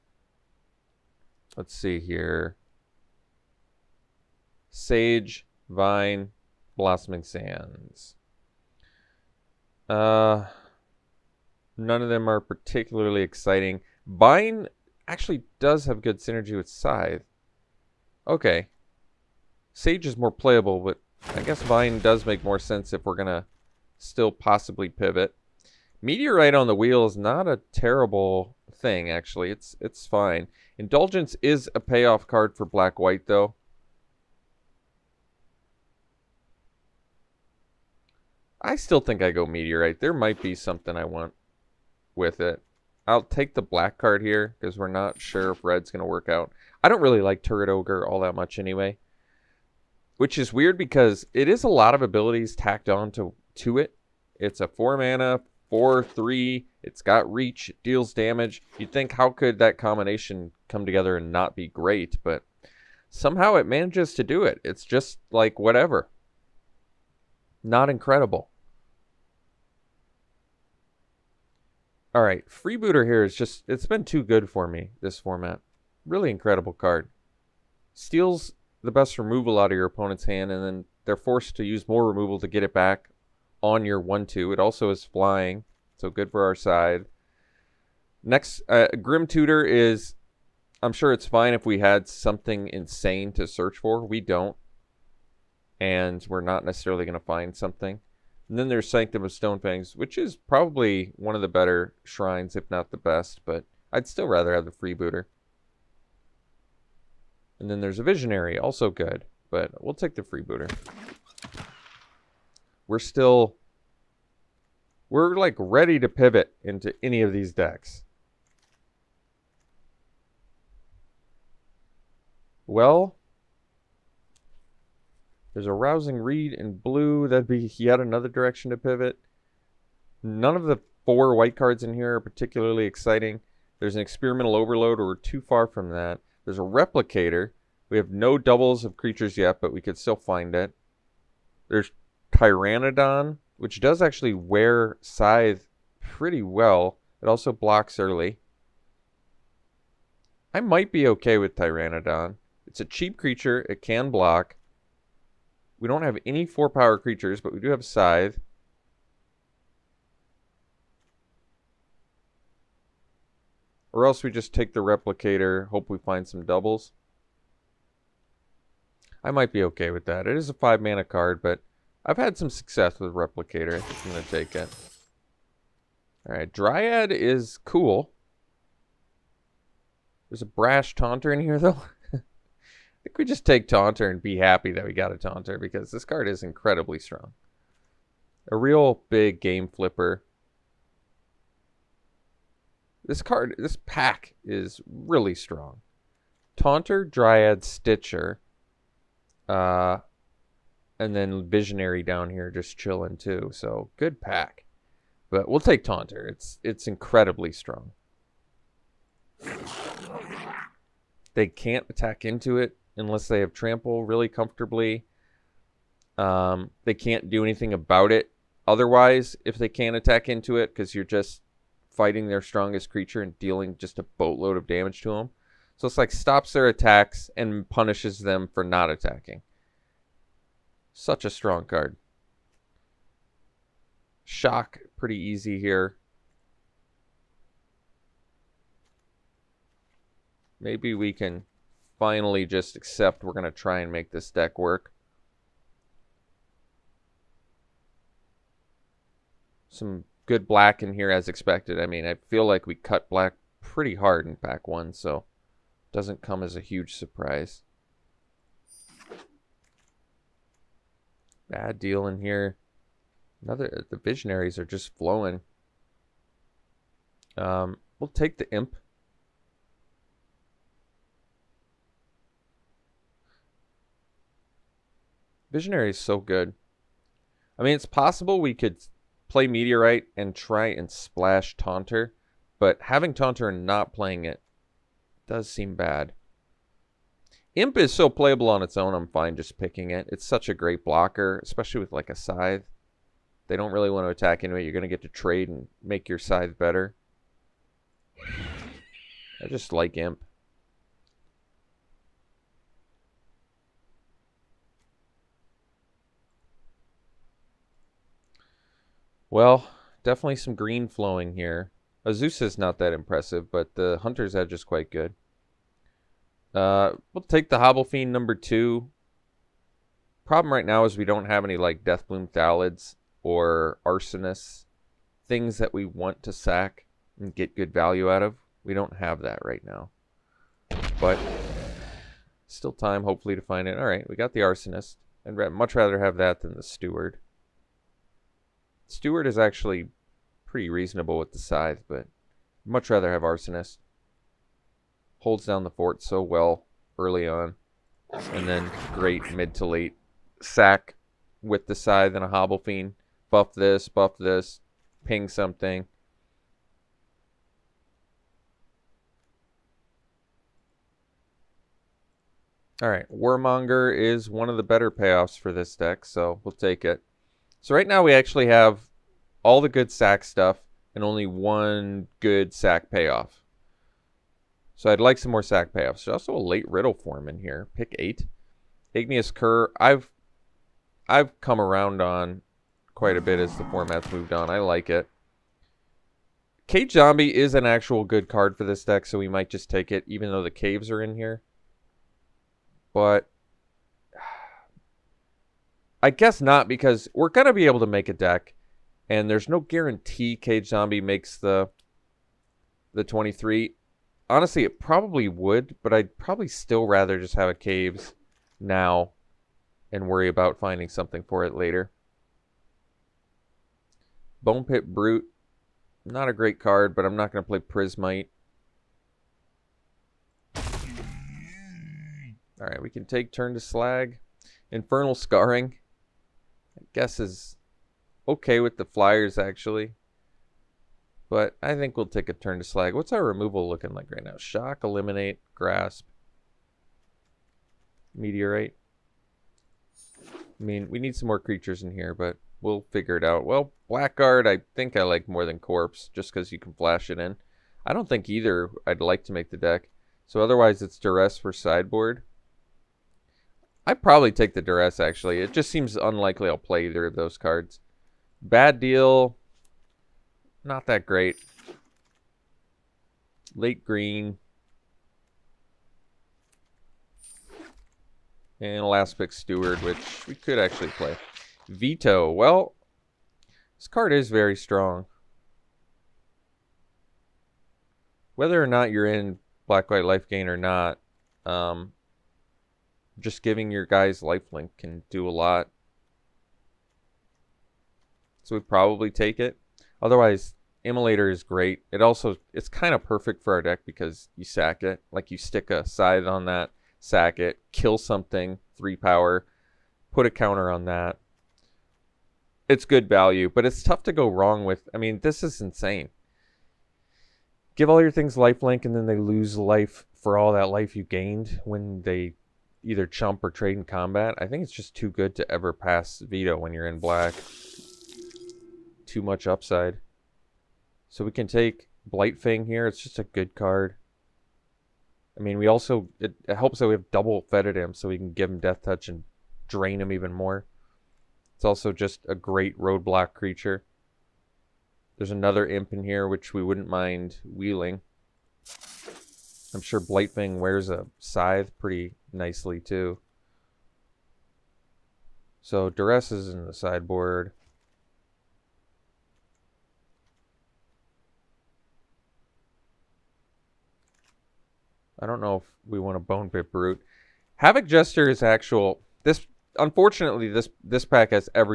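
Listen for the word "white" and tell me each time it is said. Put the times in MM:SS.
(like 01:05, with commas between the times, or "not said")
00:32, 02:11, 07:59.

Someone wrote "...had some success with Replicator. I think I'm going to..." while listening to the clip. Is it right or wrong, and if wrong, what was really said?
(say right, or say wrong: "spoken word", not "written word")
right.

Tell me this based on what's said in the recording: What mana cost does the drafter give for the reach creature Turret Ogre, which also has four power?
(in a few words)
4.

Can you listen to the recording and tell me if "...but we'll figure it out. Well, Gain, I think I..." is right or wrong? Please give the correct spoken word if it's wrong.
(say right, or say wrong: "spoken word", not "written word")
wrong: "Blackguard", not "Gain".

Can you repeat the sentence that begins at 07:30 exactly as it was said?
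So otherwise, it's Duress for sideboard i probably take the Duress, actually.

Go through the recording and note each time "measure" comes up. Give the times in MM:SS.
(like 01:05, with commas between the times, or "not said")
not said.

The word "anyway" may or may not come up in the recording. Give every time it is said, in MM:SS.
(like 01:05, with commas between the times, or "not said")
00:48, 04:54.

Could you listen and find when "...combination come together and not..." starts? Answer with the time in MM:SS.
00:59.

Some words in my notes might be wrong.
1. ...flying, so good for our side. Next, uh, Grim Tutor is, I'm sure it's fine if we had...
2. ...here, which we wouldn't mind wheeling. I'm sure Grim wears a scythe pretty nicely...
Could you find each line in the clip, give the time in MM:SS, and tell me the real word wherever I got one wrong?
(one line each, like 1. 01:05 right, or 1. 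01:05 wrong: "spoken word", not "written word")
1. 01:25 right
2. 08:56 wrong: "Blightfang", not "Grim".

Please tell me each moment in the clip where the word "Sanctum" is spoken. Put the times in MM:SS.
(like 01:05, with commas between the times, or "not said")
01:38.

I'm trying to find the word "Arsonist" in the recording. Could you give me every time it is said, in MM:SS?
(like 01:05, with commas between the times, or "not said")
05:23, 05:34, 05:43.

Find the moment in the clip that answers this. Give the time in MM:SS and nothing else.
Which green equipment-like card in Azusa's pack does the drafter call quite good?
05:14.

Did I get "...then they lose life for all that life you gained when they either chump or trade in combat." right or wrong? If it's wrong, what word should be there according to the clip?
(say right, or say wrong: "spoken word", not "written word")
right.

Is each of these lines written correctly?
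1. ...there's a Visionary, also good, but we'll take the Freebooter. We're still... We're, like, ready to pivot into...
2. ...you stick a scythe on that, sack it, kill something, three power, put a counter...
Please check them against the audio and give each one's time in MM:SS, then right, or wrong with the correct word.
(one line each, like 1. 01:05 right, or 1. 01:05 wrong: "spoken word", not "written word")
1. 01:47 right
2. 08:15 right.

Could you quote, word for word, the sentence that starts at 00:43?
I'll take the black card here because we're not sure if red's going to work out.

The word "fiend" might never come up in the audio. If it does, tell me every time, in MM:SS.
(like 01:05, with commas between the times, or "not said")
05:17, 05:52.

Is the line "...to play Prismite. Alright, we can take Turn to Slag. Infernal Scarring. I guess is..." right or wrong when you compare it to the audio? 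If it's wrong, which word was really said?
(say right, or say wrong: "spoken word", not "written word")
right.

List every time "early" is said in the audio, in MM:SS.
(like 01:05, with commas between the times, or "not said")
02:27, 05:46.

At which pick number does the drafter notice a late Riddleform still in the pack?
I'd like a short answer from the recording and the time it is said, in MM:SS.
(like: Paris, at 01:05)
8, at 06:17.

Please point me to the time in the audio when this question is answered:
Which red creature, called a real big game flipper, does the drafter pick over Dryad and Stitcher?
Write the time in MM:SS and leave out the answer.
03:00.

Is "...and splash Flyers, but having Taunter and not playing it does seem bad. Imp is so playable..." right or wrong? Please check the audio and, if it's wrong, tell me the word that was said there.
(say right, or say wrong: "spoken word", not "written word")
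wrong: "Taunter", not "Flyers".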